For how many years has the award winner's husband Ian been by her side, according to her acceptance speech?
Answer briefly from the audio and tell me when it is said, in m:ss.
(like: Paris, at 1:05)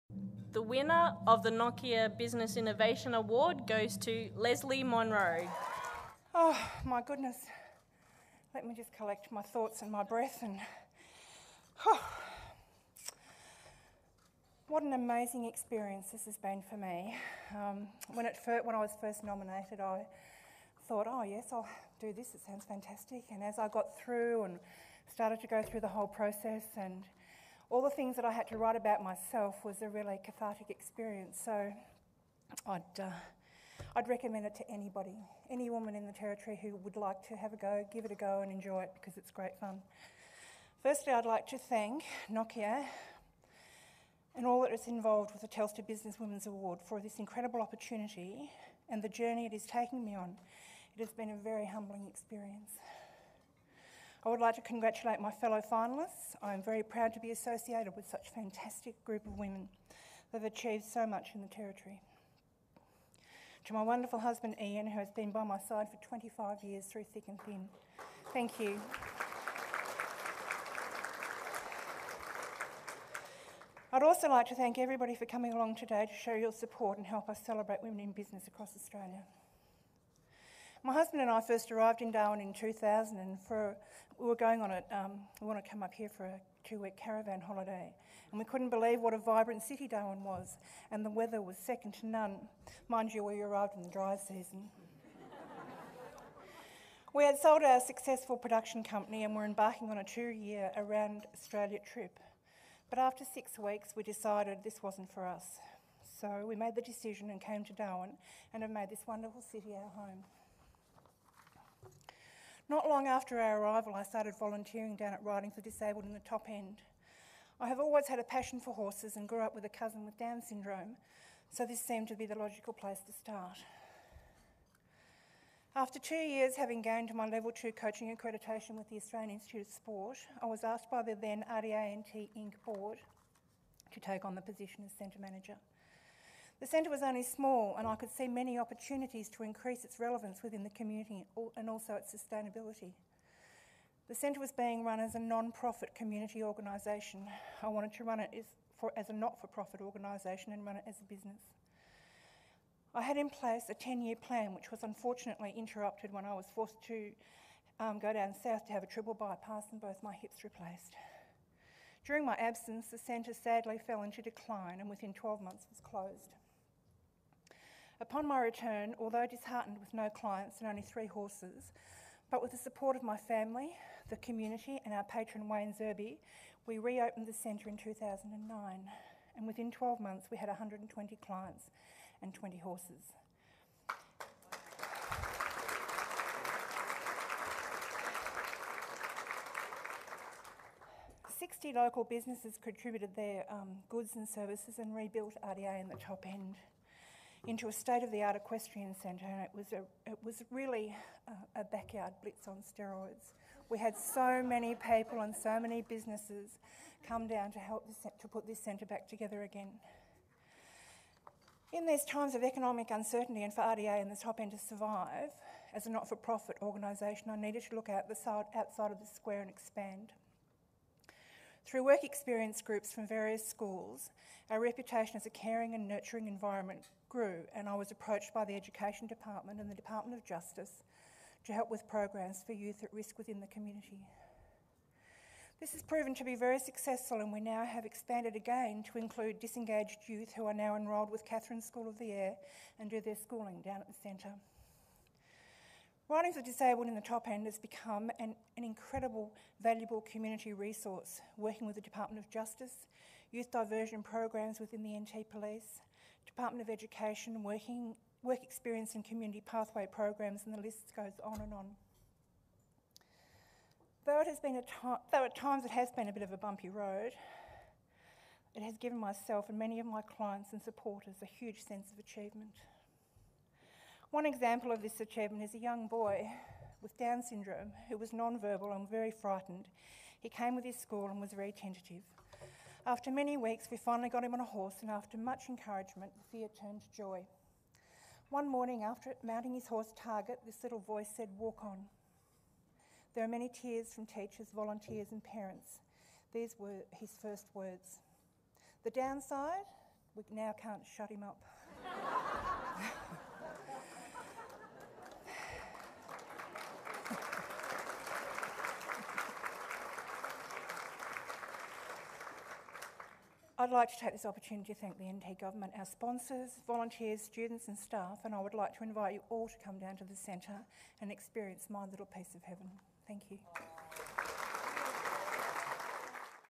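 25, at 1:06.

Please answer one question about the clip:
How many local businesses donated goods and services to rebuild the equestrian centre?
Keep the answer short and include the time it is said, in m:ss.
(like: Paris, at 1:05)
60, at 3:11.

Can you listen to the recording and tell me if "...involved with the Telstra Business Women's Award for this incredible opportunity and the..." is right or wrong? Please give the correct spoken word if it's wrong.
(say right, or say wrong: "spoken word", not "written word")
right.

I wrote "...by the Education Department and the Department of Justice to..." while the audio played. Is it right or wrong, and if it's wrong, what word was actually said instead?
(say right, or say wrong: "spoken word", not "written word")
right.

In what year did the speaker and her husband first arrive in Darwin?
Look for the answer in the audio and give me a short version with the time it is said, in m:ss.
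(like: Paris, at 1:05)
2000, at 1:22.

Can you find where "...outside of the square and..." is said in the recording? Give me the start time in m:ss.
3:38.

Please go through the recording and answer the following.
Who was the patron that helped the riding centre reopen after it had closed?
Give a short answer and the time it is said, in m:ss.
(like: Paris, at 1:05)
Wayne Zerby, at 2:55.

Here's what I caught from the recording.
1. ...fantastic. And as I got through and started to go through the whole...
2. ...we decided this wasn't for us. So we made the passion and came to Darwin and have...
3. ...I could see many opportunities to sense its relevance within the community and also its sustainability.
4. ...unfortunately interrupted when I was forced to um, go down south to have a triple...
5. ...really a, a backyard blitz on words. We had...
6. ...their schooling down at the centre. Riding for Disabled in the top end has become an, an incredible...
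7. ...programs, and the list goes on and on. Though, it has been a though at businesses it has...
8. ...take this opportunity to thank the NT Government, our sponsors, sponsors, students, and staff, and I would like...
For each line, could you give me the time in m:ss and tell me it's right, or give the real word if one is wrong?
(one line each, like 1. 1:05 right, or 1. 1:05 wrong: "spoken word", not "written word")
1. 0:22 right
2. 1:43 wrong: "decision", not "passion"
3. 2:17 wrong: "increase", not "sense"
4. 2:34 right
5. 3:20 wrong: "steroids", not "words"
6. 4:02 right
7. 4:19 wrong: "times", not "businesses"
8. 5:14 wrong: "volunteers", not "sponsors".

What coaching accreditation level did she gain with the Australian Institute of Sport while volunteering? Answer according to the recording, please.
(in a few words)
Level 2.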